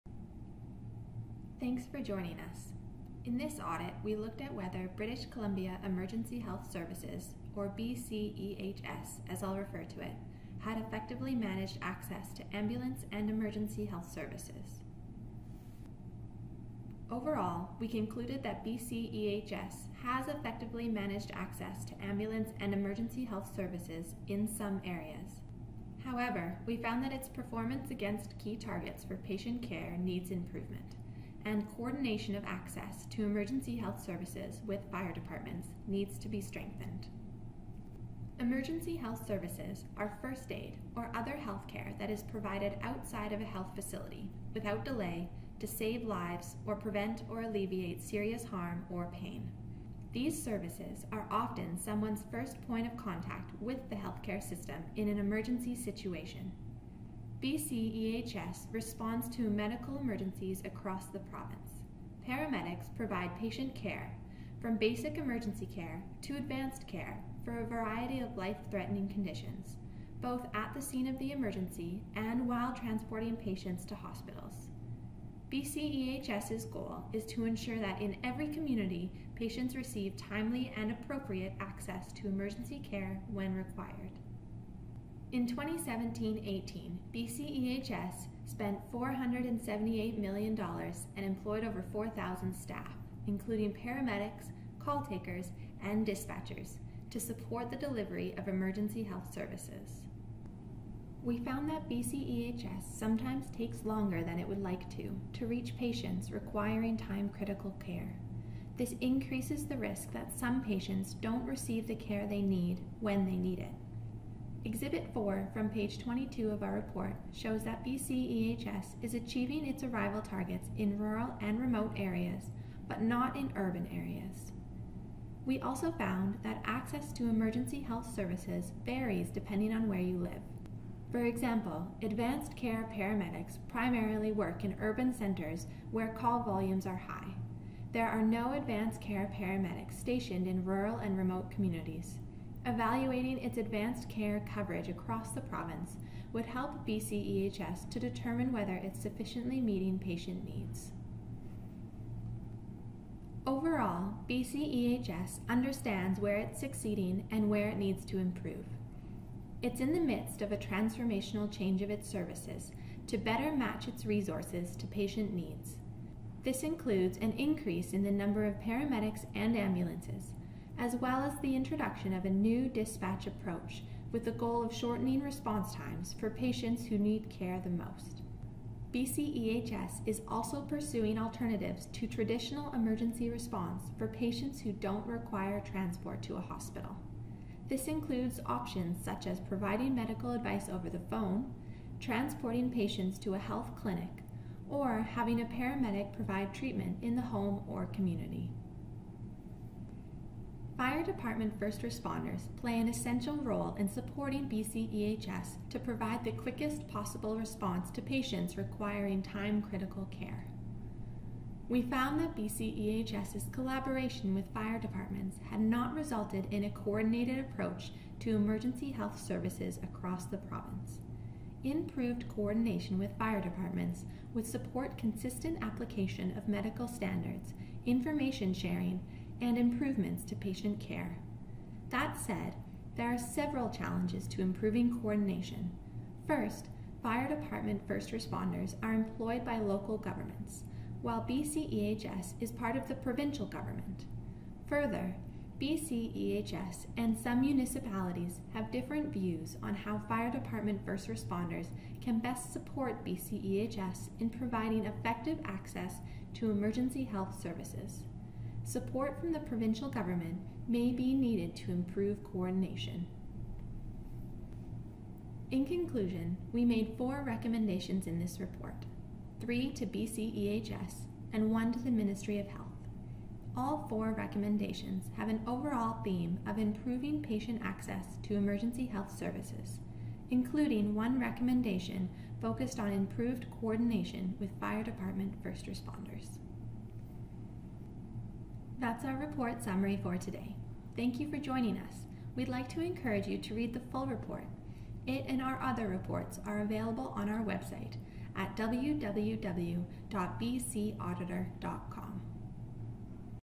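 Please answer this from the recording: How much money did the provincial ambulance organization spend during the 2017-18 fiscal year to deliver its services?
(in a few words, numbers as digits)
$478 million.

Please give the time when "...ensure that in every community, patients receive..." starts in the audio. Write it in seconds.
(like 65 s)
77 s.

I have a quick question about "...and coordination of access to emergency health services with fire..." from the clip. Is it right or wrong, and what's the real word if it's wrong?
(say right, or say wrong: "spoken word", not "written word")
right.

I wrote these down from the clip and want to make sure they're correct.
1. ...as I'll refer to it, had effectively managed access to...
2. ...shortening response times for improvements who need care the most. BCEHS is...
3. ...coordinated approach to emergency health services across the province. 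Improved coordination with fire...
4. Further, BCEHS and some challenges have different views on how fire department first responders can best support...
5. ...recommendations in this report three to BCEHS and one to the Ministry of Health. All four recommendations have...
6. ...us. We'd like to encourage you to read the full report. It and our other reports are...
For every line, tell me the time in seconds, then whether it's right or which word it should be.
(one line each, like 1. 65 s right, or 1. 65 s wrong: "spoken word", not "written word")
1. 9 s right
2. 174 s wrong: "patients", not "improvements"
3. 216 s right
4. 244 s wrong: "municipalities", not "challenges"
5. 267 s right
6. 291 s right.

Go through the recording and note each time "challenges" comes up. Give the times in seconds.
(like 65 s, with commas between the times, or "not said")
233 s.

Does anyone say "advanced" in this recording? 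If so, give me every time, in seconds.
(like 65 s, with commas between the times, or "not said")
66 s, 132 s, 138 s, 143 s.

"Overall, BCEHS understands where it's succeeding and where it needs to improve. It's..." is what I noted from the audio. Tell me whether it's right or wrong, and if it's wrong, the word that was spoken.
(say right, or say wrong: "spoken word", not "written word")
right.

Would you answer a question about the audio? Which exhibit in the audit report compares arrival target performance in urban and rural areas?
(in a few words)
Exhibit 4.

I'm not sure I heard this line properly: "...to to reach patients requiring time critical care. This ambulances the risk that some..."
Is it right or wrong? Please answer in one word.
wrong.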